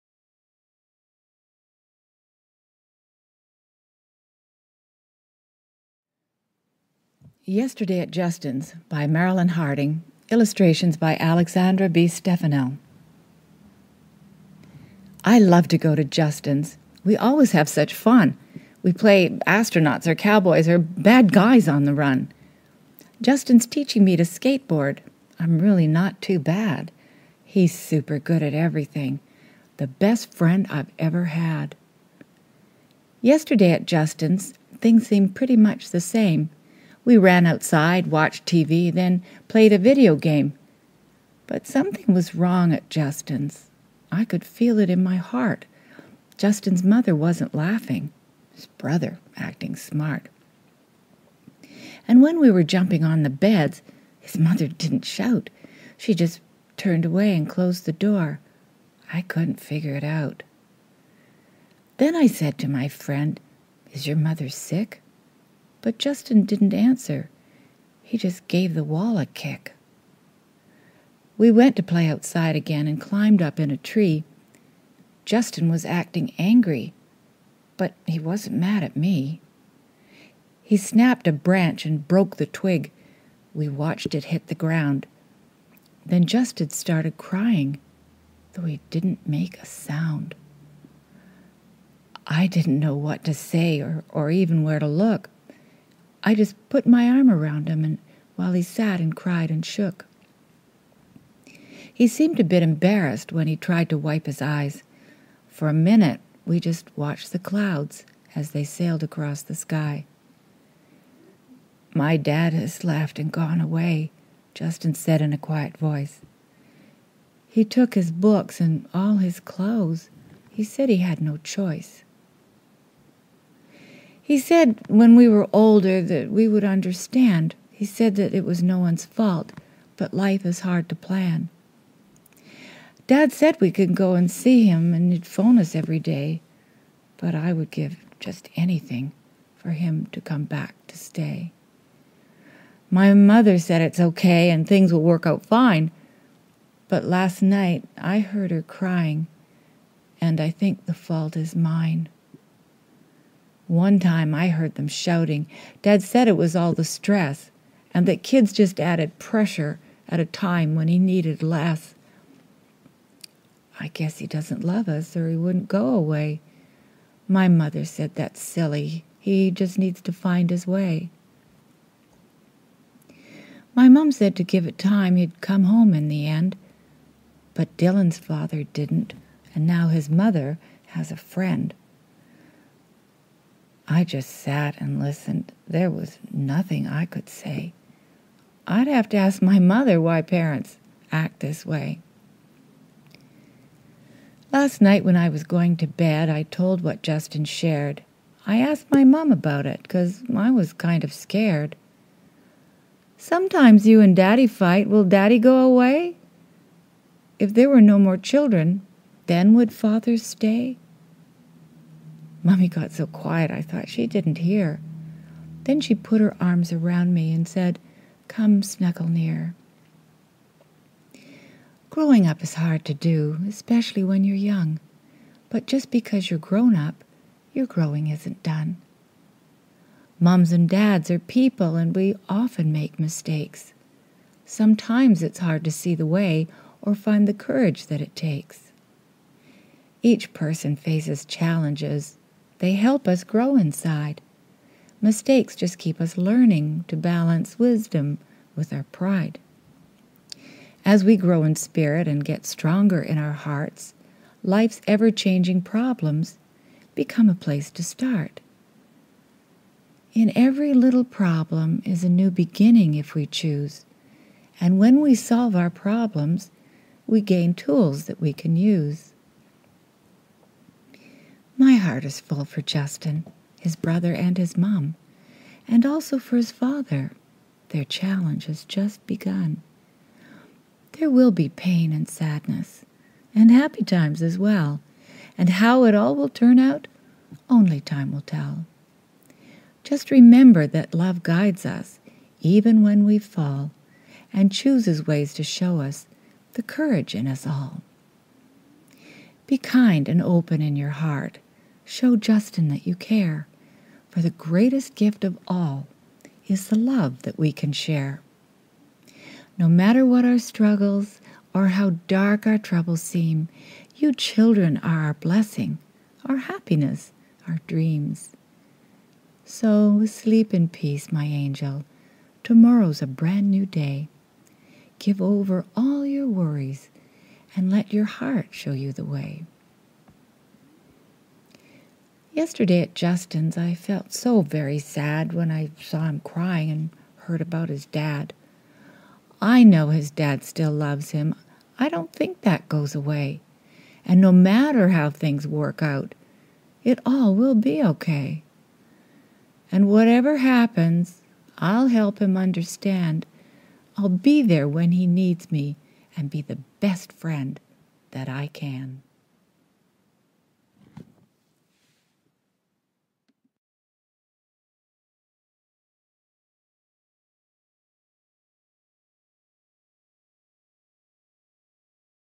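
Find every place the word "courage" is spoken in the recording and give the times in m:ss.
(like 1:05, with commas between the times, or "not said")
3:57, 4:56.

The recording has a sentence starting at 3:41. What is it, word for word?
Growing up is hard to do, especially when you're young.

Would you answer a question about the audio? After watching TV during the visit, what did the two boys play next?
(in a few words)
A video game.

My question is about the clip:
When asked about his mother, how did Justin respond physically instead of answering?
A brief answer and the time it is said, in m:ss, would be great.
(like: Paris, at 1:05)
Gave the wall a kick, at 1:08.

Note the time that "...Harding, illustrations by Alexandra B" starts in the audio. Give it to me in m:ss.
0:09.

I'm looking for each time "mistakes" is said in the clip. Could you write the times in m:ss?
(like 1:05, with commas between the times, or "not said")
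3:52, 4:05.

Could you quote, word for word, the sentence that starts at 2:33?
One time I heard them shouting.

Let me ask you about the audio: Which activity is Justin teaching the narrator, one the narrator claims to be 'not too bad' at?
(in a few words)
Skateboard.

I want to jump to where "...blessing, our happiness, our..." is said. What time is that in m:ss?
5:15.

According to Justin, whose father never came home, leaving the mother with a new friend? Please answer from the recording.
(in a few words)
Dylan's.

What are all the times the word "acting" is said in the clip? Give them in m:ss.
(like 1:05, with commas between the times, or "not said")
0:49, 1:15.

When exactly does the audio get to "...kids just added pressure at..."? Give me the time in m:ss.
2:38.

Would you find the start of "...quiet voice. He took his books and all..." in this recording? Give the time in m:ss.
1:55.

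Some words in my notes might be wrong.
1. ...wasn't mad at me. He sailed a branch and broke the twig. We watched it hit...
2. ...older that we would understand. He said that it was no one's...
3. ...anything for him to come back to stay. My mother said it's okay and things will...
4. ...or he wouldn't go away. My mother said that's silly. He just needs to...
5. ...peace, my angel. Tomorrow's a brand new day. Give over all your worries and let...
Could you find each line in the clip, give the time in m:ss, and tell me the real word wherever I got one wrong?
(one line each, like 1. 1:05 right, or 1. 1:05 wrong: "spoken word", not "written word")
1. 1:18 wrong: "snapped", not "sailed"
2. 2:05 right
3. 2:18 right
4. 2:45 right
5. 5:20 right.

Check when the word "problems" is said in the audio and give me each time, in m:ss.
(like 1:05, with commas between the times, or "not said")
4:15, 4:21, 4:25.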